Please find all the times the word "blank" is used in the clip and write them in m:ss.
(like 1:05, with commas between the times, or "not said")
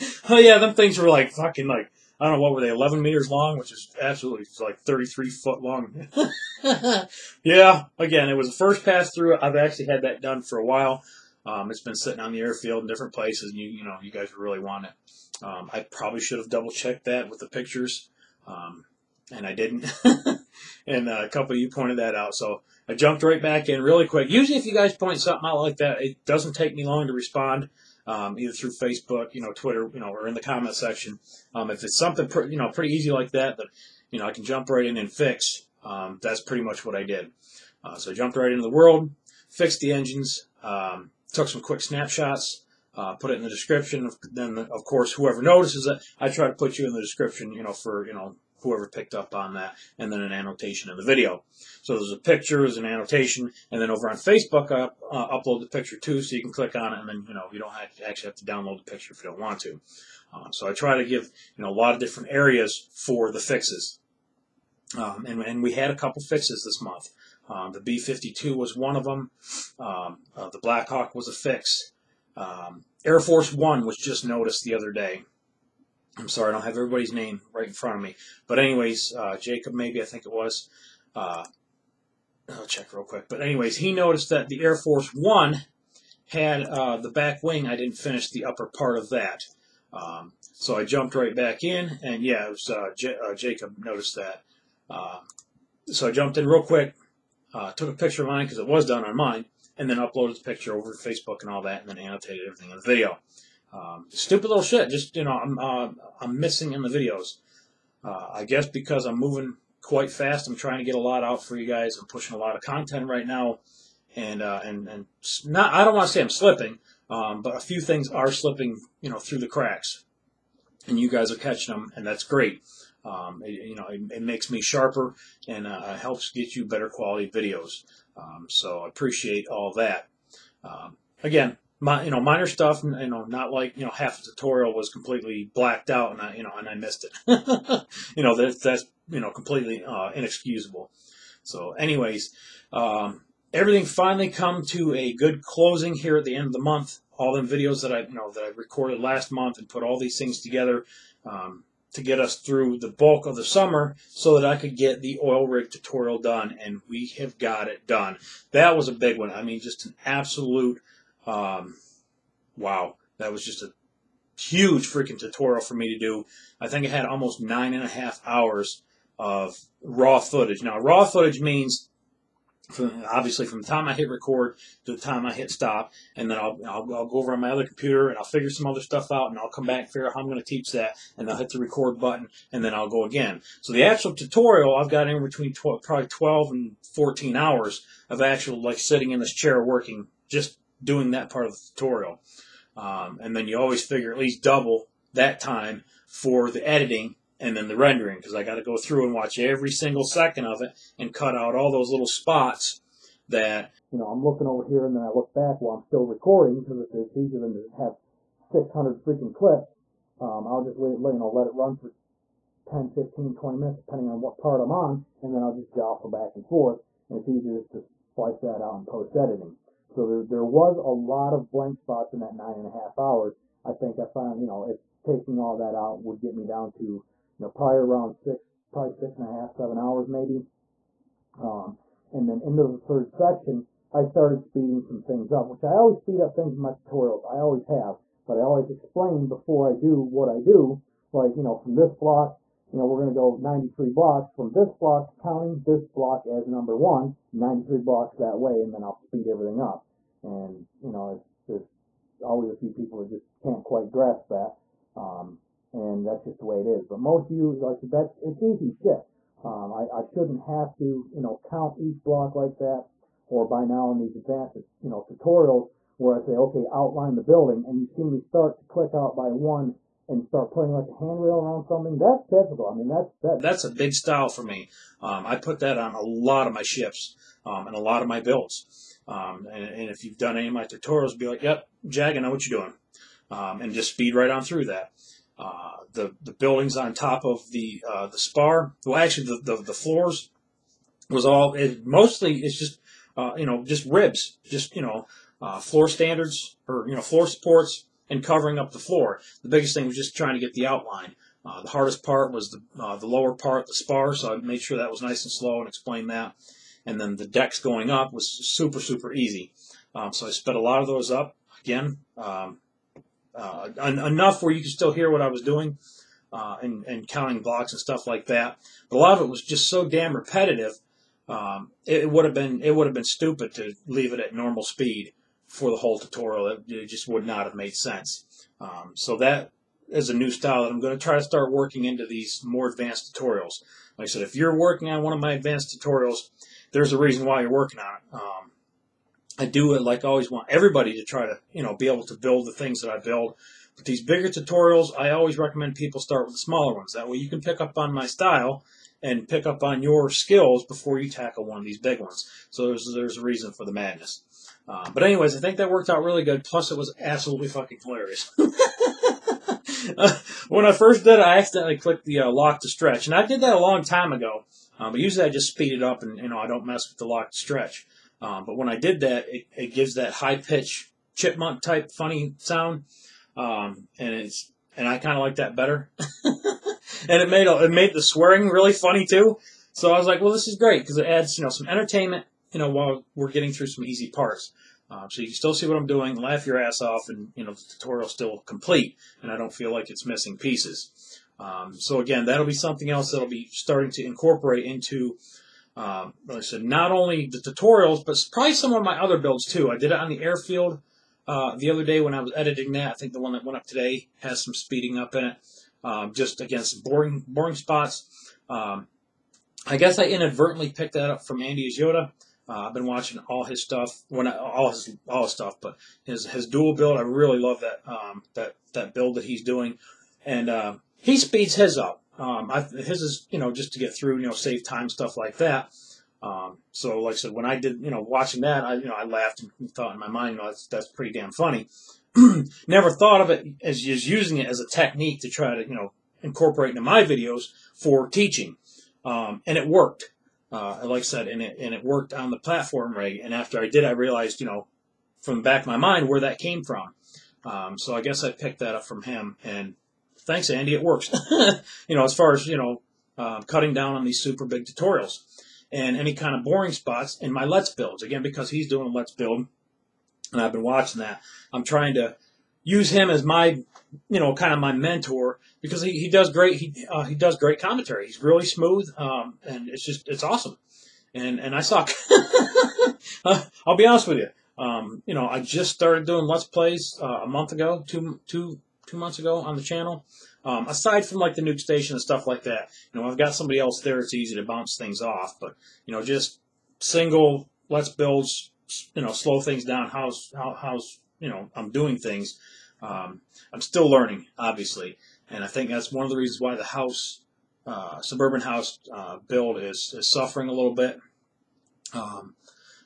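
3:41.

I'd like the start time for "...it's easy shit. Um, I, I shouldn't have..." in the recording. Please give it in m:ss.
4:18.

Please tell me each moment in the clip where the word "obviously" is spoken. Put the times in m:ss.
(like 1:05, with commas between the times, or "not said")
2:53, 8:14.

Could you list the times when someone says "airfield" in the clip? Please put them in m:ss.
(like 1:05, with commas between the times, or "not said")
0:12, 6:40.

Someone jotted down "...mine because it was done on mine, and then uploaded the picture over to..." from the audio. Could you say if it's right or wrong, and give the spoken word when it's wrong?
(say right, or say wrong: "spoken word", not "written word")
right.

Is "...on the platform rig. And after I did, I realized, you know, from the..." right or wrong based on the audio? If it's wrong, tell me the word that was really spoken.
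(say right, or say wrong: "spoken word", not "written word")
right.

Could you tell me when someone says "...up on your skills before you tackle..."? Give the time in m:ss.
5:49.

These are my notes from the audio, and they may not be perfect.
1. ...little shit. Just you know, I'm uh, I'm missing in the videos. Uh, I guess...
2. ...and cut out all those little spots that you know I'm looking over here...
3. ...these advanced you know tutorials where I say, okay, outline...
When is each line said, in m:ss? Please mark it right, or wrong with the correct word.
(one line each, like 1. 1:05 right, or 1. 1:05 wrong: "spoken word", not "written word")
1. 1:44 right
2. 3:20 right
3. 4:23 right.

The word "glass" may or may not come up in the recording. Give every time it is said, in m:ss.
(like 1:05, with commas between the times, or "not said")
not said.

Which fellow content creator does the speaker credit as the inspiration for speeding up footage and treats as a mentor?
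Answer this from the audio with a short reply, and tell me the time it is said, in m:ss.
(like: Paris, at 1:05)
Andy Yoda, at 6:51.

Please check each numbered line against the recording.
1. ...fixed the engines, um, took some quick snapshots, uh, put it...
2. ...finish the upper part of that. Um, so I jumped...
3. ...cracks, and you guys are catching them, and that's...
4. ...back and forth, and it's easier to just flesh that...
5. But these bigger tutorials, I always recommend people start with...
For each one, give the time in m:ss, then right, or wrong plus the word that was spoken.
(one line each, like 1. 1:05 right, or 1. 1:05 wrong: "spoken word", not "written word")
1. 0:39 right
2. 1:27 right
3. 1:59 right
4. 3:36 right
5. 5:43 right.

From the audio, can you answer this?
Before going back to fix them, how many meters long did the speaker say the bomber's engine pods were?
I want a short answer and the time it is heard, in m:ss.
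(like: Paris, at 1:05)
11 meters, at 0:02.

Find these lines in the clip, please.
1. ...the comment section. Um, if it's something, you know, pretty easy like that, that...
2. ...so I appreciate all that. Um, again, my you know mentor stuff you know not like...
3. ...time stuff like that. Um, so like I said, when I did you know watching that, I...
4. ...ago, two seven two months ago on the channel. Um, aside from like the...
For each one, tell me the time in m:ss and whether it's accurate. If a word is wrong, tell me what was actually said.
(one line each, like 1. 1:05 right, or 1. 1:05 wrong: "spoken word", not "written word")
1. 0:30 right
2. 2:08 wrong: "minor", not "mentor"
3. 7:04 right
4. 7:57 wrong: "two", not "seven".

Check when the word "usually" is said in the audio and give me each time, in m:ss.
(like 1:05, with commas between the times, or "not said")
0:24, 6:05.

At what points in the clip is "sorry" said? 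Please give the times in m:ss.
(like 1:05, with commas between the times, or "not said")
1:16.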